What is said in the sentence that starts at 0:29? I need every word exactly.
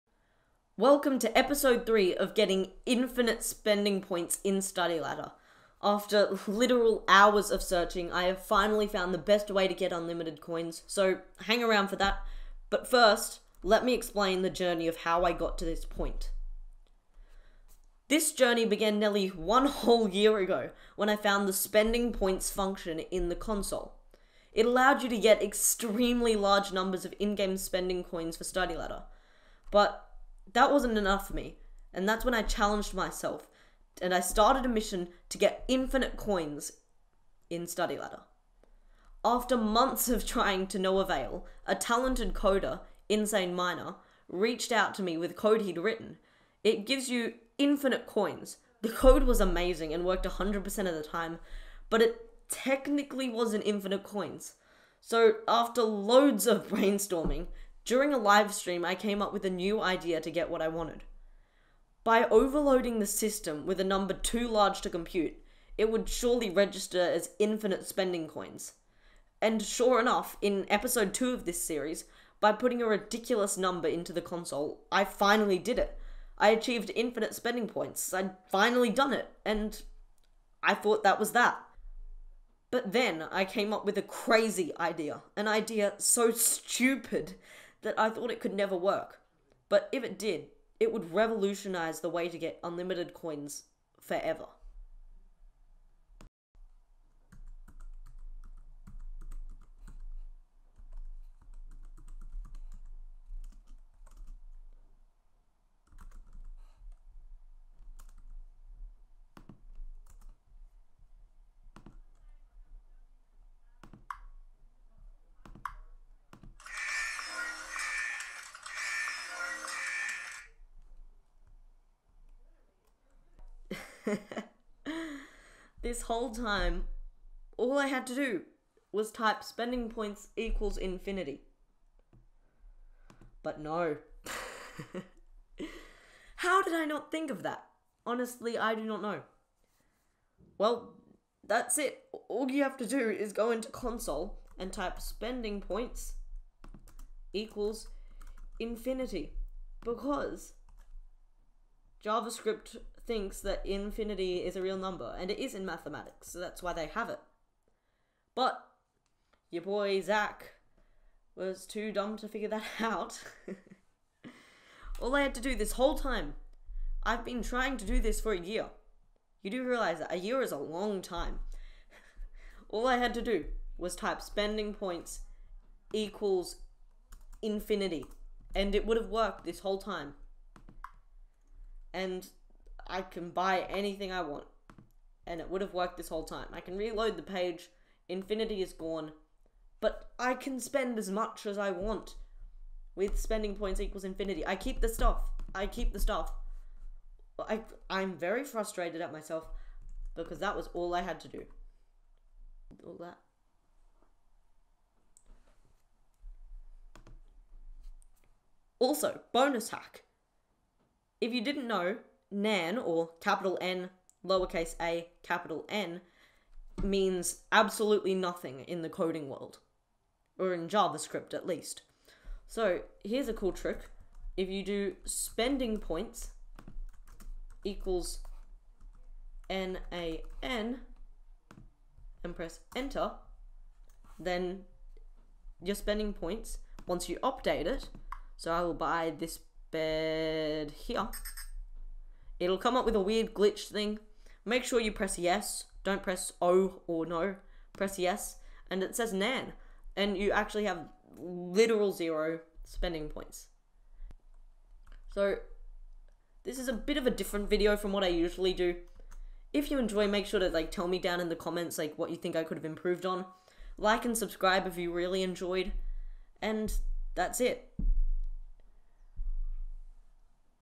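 But that wasn't enough for me.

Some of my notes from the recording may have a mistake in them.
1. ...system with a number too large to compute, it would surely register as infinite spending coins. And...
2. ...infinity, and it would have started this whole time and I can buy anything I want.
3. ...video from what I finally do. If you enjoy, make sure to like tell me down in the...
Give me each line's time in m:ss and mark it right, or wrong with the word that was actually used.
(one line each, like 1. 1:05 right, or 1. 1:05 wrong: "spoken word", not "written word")
1. 1:03 right
2. 2:57 wrong: "worked", not "started"
3. 4:17 wrong: "usually", not "finally".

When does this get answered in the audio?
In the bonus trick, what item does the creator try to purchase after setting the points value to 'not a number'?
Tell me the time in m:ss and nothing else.
3:59.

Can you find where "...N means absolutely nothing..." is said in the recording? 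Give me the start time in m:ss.
3:35.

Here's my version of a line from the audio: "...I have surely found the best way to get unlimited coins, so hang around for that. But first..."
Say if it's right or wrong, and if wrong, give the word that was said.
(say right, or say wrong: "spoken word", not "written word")
wrong: "finally", not "surely".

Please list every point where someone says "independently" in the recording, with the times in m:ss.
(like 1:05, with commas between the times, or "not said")
not said.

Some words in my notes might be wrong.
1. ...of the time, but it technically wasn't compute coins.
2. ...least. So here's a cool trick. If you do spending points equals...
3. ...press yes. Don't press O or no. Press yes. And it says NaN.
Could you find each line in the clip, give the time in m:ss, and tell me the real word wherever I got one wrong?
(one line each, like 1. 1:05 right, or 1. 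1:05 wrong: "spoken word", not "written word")
1. 0:50 wrong: "infinite", not "compute"
2. 3:41 right
3. 4:04 right.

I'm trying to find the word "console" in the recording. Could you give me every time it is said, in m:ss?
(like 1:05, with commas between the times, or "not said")
0:23, 1:14, 2:23.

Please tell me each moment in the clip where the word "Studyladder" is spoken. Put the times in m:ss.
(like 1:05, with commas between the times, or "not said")
0:04, 0:28, 0:37.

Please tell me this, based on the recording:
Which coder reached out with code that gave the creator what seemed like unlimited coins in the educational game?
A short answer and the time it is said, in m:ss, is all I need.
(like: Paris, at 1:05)
Insane Miner, at 0:43.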